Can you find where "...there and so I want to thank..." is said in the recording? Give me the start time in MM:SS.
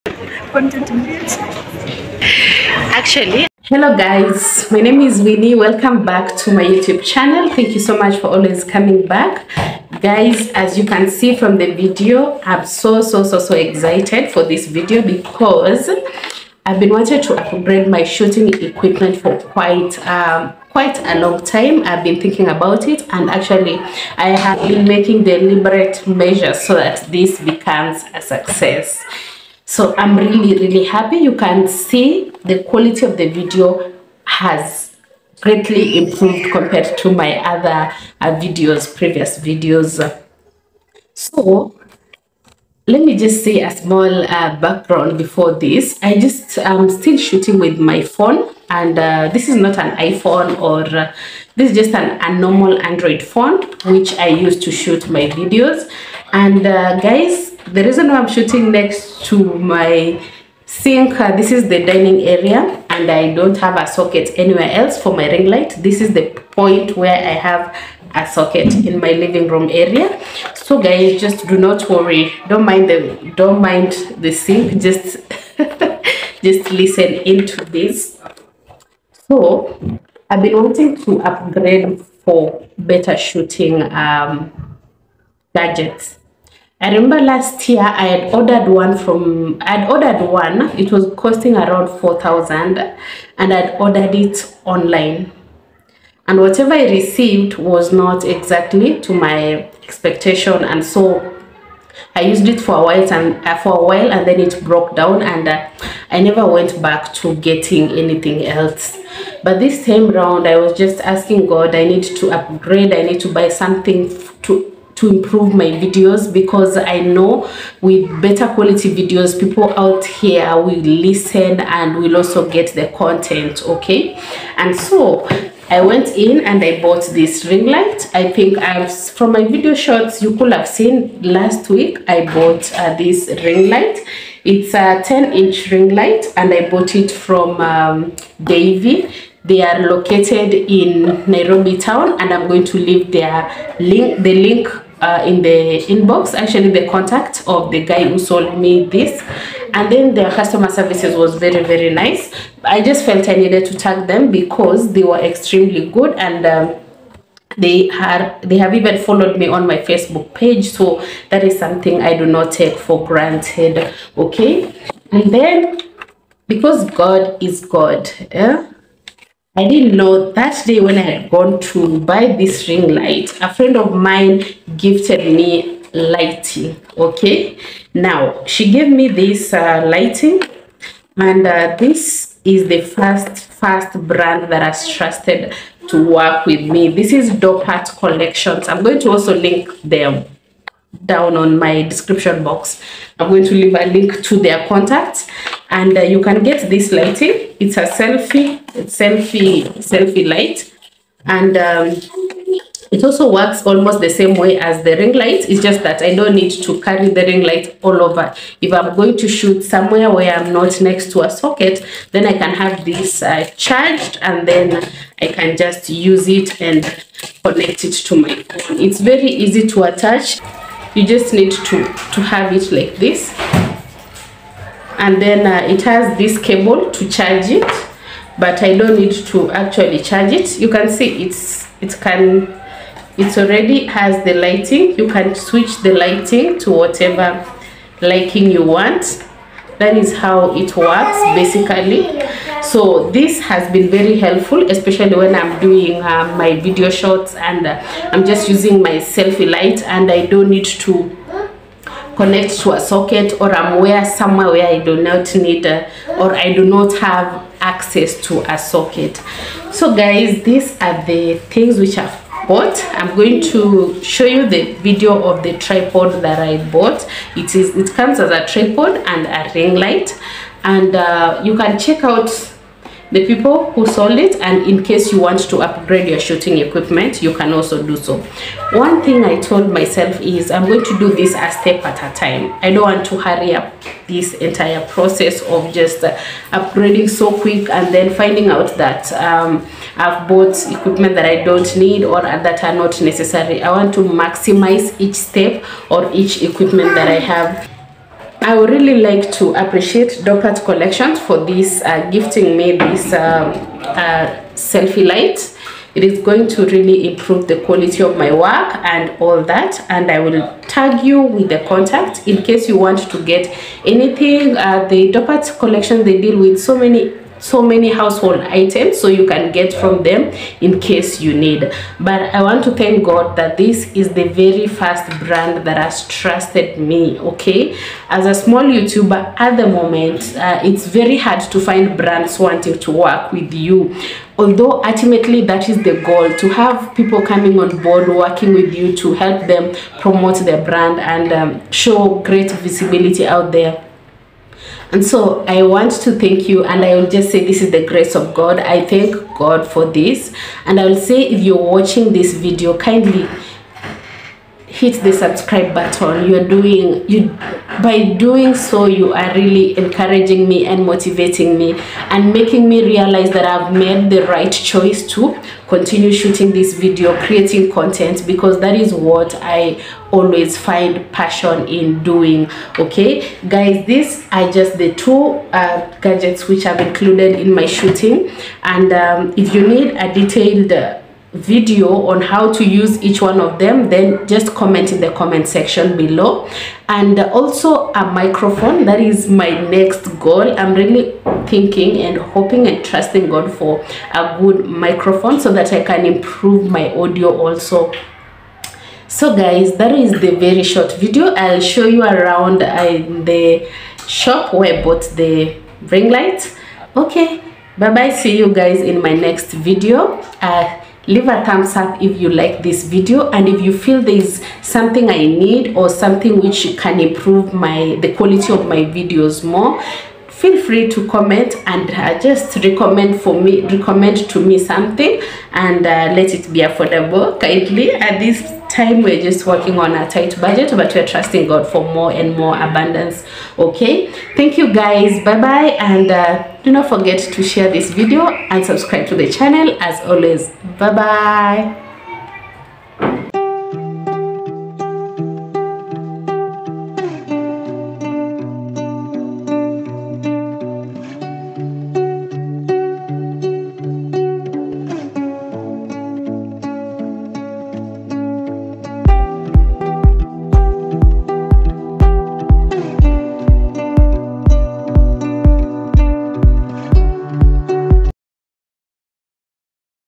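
05:43.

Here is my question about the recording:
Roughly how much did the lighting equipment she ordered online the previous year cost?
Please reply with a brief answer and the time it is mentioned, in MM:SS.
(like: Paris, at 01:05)
4,000, at 01:31.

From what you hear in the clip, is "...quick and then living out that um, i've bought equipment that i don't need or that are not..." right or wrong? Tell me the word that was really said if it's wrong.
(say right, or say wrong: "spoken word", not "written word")
wrong: "finding", not "living".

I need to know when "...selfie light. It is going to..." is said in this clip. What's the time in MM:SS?
05:04.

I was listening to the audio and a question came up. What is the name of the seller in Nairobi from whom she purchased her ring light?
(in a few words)
Daivy.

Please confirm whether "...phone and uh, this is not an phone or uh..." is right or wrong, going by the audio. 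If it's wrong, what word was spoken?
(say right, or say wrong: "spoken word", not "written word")
wrong: "iPhone", not "phone".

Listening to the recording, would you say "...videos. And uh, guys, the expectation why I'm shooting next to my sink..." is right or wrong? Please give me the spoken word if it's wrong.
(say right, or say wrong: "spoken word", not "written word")
wrong: "reason", not "expectation".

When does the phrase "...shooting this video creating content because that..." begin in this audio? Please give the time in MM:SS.
06:06.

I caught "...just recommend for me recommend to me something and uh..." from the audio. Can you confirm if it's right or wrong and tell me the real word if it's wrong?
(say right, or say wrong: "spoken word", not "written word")
right.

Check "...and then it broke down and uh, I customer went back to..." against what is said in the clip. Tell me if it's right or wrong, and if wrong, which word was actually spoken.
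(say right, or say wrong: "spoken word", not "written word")
wrong: "never", not "customer".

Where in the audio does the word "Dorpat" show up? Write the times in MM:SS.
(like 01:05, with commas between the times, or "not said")
03:07, 05:00, 05:15.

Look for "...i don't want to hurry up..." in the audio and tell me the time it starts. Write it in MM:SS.
04:42.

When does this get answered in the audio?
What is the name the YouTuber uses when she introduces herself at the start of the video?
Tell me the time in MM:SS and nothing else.
00:05.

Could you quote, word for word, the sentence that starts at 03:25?
It's just that I don't need to carry the ring light all over.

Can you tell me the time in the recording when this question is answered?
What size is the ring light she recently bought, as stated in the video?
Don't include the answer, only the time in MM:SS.
02:15.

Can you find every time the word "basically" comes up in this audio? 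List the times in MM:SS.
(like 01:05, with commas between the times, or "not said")
04:01.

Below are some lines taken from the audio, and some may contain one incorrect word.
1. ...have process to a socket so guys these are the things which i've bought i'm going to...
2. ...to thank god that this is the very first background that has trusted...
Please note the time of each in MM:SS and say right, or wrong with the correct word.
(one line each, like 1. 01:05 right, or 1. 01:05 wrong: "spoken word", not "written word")
1. 04:16 wrong: "access", not "process"
2. 05:22 wrong: "brand", not "background".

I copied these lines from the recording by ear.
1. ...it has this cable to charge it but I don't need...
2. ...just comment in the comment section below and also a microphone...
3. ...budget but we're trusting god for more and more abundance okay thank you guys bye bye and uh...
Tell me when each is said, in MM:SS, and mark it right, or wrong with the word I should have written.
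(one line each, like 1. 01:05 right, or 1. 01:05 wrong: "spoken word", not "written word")
1. 03:45 right
2. 06:24 right
3. 07:10 right.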